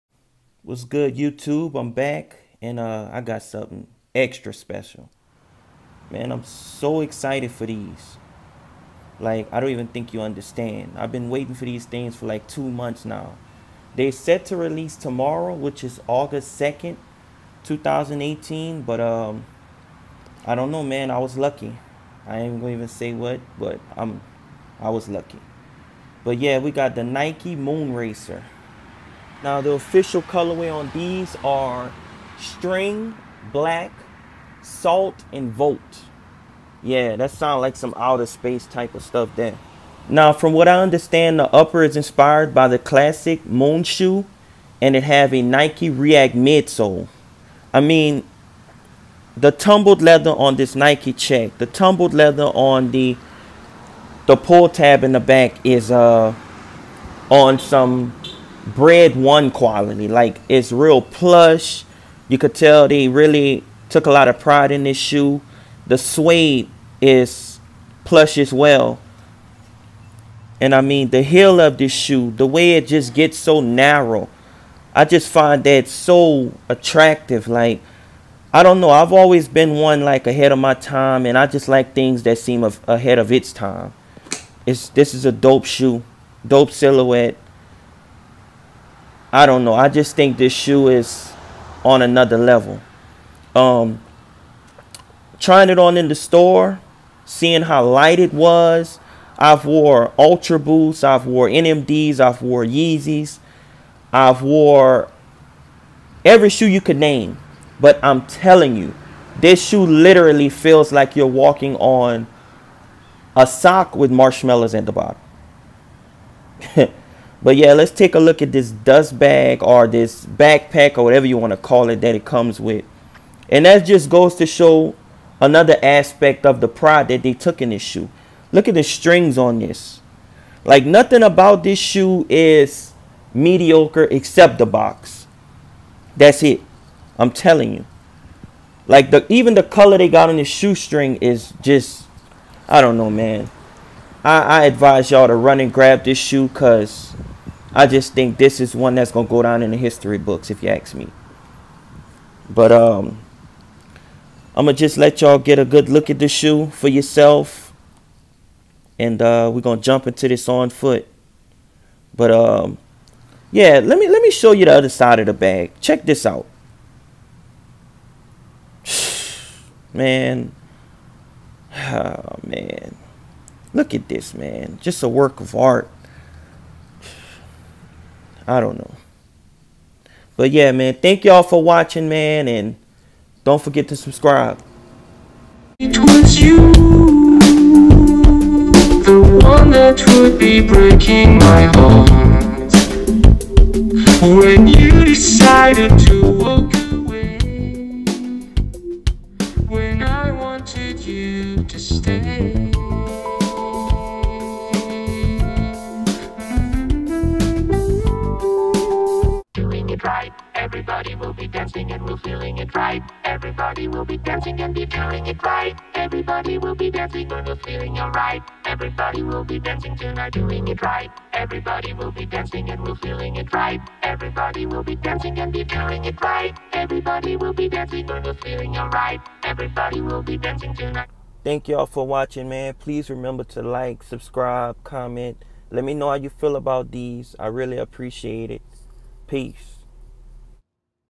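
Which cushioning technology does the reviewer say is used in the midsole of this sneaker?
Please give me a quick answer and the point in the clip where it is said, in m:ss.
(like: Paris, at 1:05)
Nike React, at 0:45.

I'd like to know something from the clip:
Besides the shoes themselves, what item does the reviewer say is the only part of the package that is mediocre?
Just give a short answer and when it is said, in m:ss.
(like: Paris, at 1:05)
The box, at 2:14.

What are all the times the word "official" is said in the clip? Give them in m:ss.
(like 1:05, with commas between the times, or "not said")
0:29.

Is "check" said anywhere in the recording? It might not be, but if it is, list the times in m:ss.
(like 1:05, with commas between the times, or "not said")
0:51, 2:45.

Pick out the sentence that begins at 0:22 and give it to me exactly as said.
I ain't gonna even say what, but I'm, I was lucky.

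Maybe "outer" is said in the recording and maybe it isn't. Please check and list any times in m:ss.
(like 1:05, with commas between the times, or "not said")
0:37.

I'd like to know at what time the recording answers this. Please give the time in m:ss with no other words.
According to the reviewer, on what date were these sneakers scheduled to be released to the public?
0:16.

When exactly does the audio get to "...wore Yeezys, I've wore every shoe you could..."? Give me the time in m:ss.
1:42.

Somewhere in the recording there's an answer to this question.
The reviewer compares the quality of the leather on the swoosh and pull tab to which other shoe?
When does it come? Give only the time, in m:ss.
0:58.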